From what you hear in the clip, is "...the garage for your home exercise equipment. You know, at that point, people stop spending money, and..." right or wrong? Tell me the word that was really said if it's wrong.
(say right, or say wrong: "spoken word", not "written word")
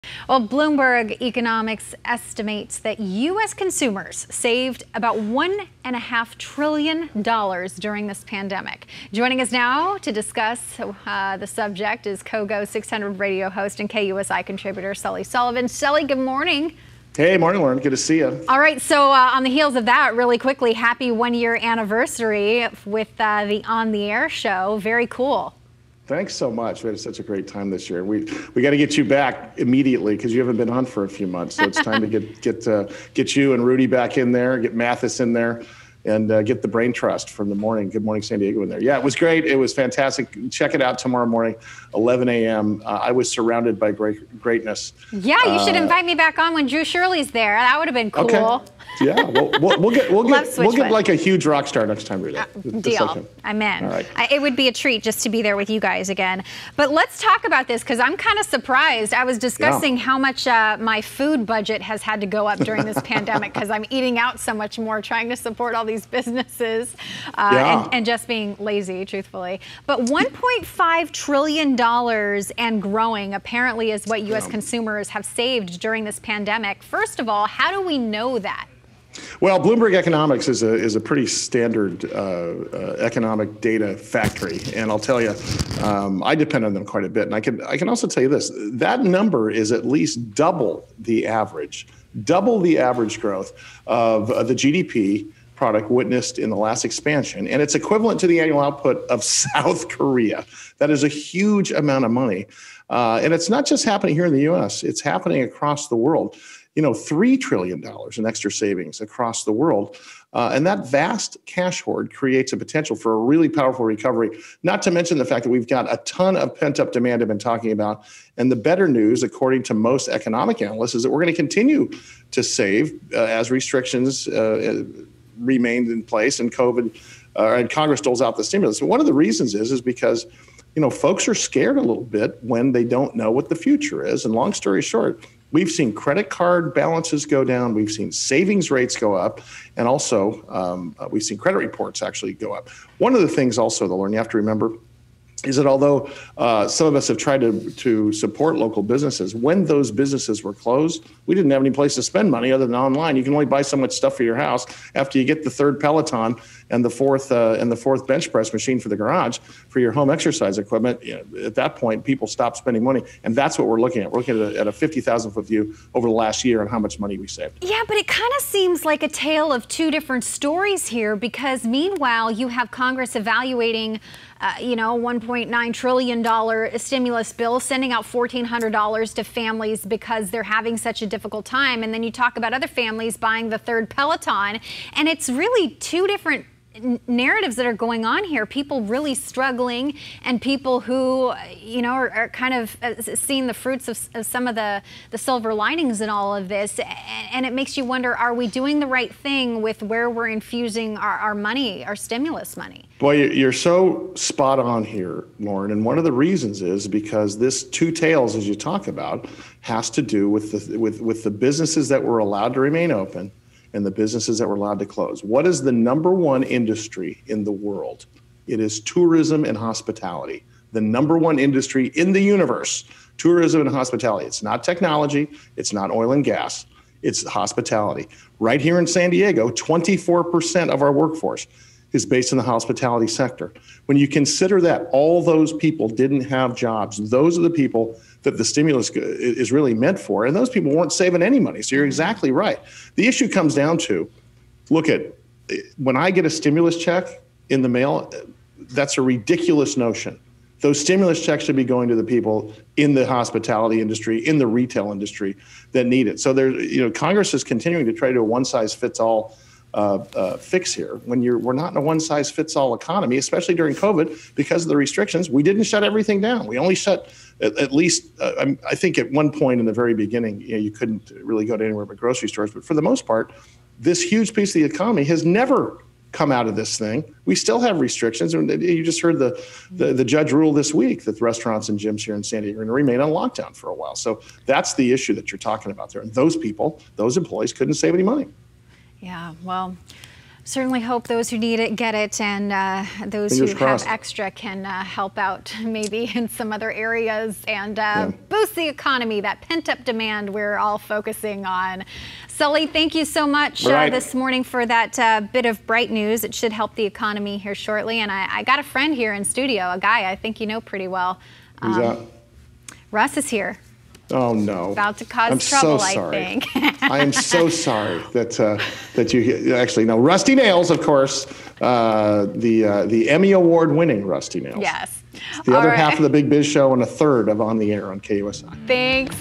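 right.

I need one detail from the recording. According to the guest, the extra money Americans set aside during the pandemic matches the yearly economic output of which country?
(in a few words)
South Korea.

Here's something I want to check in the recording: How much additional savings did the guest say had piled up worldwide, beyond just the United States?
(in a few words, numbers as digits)
$3 trillion.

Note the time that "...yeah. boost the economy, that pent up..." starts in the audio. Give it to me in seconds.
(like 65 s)
297 s.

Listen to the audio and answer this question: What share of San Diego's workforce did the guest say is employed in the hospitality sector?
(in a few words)
24%.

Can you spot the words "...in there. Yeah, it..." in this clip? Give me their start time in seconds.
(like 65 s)
38 s.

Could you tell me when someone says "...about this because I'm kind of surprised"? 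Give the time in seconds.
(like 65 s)
57 s.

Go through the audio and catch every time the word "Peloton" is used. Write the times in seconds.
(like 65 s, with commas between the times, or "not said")
155 s, 183 s.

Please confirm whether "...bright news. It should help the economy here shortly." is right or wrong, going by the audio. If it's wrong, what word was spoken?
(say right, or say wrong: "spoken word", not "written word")
right.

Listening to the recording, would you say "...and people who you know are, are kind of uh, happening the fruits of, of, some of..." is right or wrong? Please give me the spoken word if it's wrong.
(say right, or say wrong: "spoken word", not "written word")
wrong: "seeing", not "happening".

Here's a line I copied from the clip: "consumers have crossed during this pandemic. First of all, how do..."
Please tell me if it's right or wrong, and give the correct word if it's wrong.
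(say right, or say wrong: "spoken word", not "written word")
wrong: "saved", not "crossed".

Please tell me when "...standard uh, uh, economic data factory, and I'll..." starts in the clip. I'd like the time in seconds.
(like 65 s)
81 s.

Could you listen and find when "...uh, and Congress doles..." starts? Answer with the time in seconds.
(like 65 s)
127 s.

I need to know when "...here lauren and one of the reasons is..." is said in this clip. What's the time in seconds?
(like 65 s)
204 s.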